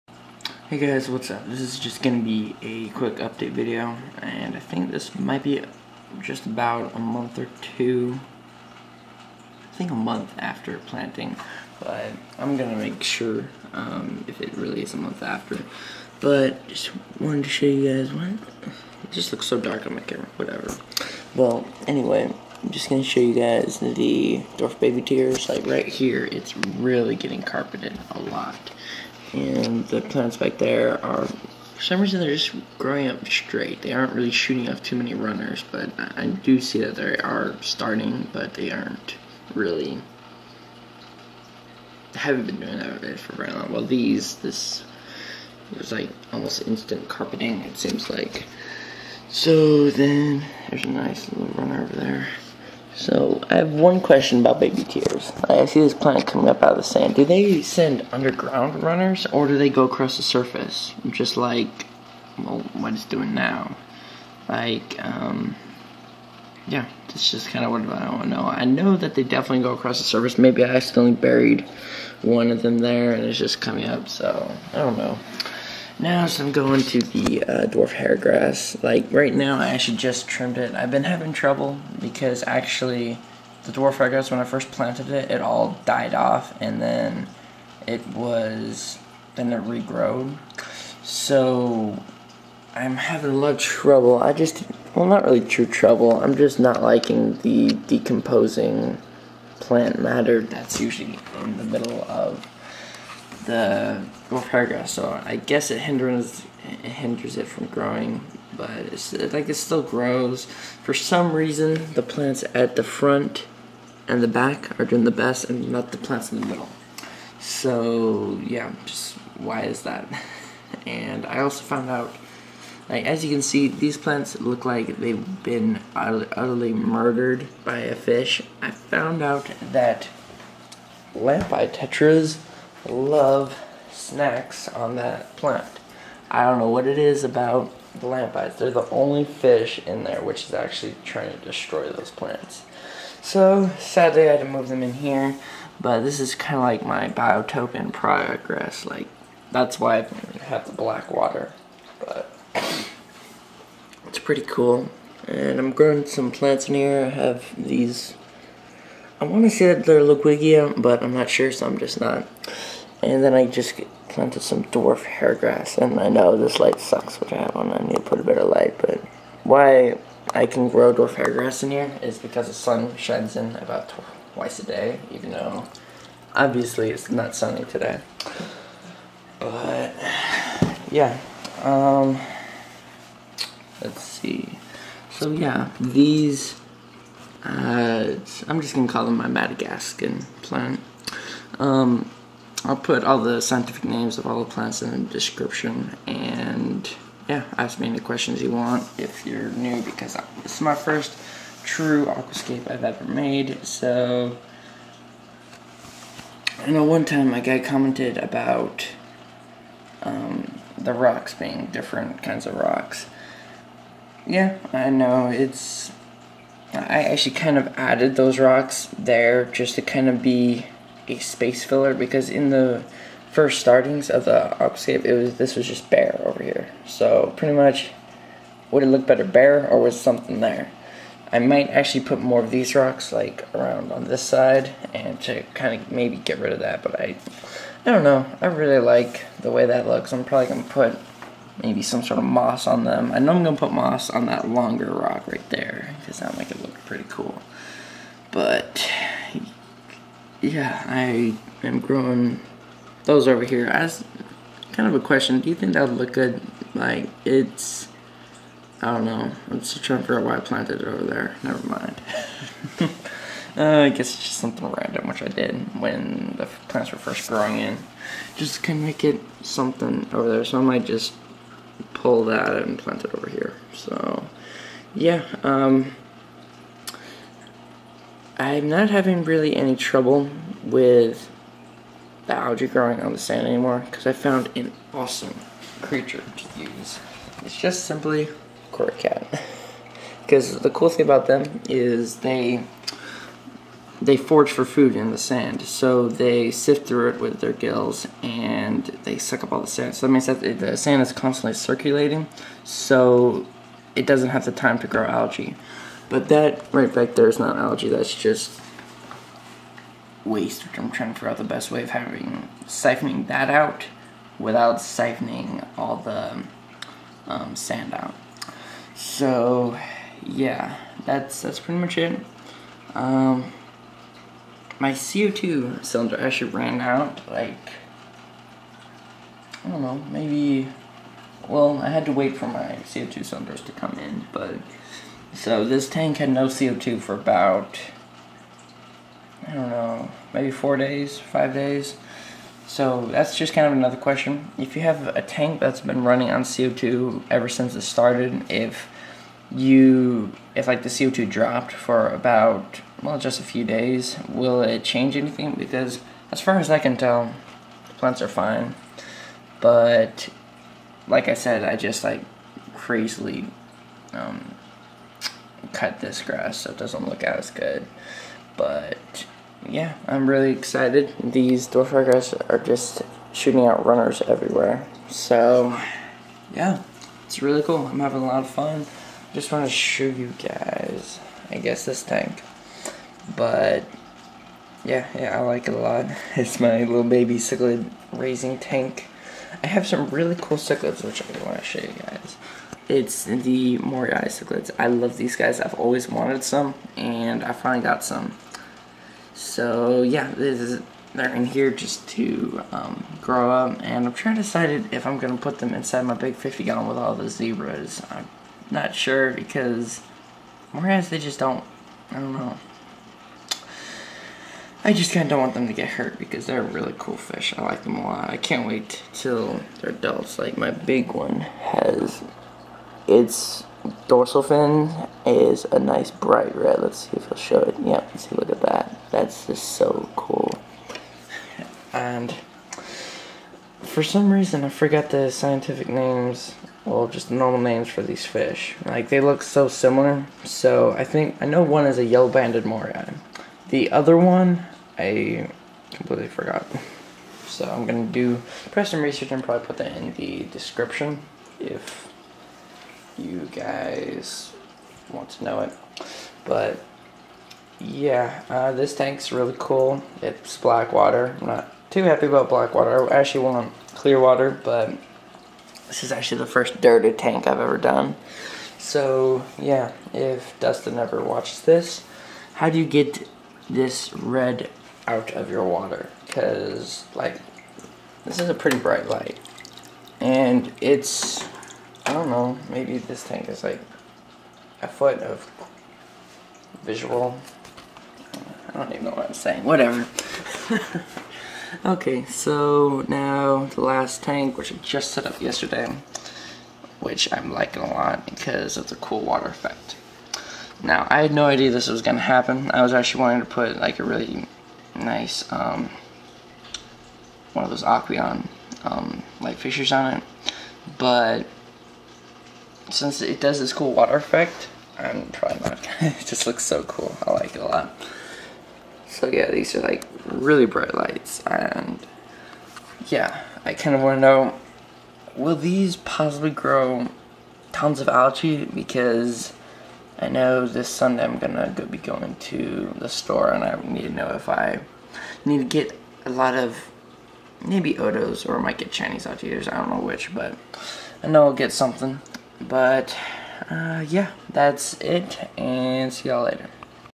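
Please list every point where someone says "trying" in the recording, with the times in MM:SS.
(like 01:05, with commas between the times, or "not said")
02:21, 04:19, 05:10, 06:44.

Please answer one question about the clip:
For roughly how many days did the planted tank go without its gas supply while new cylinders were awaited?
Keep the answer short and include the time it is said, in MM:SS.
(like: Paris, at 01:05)
4 or 5 days, at 05:40.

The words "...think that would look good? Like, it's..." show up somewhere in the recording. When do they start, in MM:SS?
04:15.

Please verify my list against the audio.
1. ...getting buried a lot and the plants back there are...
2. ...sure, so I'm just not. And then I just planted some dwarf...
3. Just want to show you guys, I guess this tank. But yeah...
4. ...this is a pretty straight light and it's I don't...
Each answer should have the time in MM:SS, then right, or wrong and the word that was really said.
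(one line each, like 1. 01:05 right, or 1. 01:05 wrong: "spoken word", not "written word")
1. 00:27 wrong: "carpeted", not "buried"
2. 02:41 right
3. 06:19 right
4. 07:58 wrong: "bright", not "straight".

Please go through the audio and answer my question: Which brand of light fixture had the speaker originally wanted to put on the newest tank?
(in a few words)
Aqueon.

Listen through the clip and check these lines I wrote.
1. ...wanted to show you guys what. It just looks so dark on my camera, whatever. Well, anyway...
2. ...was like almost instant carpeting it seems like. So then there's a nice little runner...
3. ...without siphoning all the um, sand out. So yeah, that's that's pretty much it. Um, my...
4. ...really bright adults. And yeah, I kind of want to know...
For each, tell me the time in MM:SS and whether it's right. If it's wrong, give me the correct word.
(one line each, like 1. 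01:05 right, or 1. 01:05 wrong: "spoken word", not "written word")
1. 00:17 right
2. 00:45 right
3. 05:14 right
4. 08:40 wrong: "lights", not "adults".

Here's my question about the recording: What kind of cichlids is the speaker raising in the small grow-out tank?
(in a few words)
Moorii cichlids.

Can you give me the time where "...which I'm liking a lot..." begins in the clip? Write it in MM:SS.
08:16.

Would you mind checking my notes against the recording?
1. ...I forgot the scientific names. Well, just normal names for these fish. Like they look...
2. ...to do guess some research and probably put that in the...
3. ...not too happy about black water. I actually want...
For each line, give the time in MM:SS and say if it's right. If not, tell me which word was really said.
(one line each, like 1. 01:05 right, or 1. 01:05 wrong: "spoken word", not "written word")
1. 07:14 right
2. 07:28 wrong: "press", not "guess"
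3. 07:41 right.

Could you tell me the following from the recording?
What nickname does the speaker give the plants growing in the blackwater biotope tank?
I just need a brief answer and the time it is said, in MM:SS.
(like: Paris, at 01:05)
Madagascar plant, at 03:09.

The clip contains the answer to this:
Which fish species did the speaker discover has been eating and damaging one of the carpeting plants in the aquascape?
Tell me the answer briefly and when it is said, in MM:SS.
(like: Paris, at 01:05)
Lampeye tetras, at 02:11.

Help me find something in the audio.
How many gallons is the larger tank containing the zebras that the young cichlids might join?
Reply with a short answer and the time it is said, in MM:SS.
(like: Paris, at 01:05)
50, at 06:46.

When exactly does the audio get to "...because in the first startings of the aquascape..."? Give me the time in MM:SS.
03:41.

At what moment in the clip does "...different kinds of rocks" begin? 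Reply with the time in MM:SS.
03:31.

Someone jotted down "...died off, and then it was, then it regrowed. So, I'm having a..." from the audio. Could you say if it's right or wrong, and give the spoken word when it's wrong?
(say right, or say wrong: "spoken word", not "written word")
right.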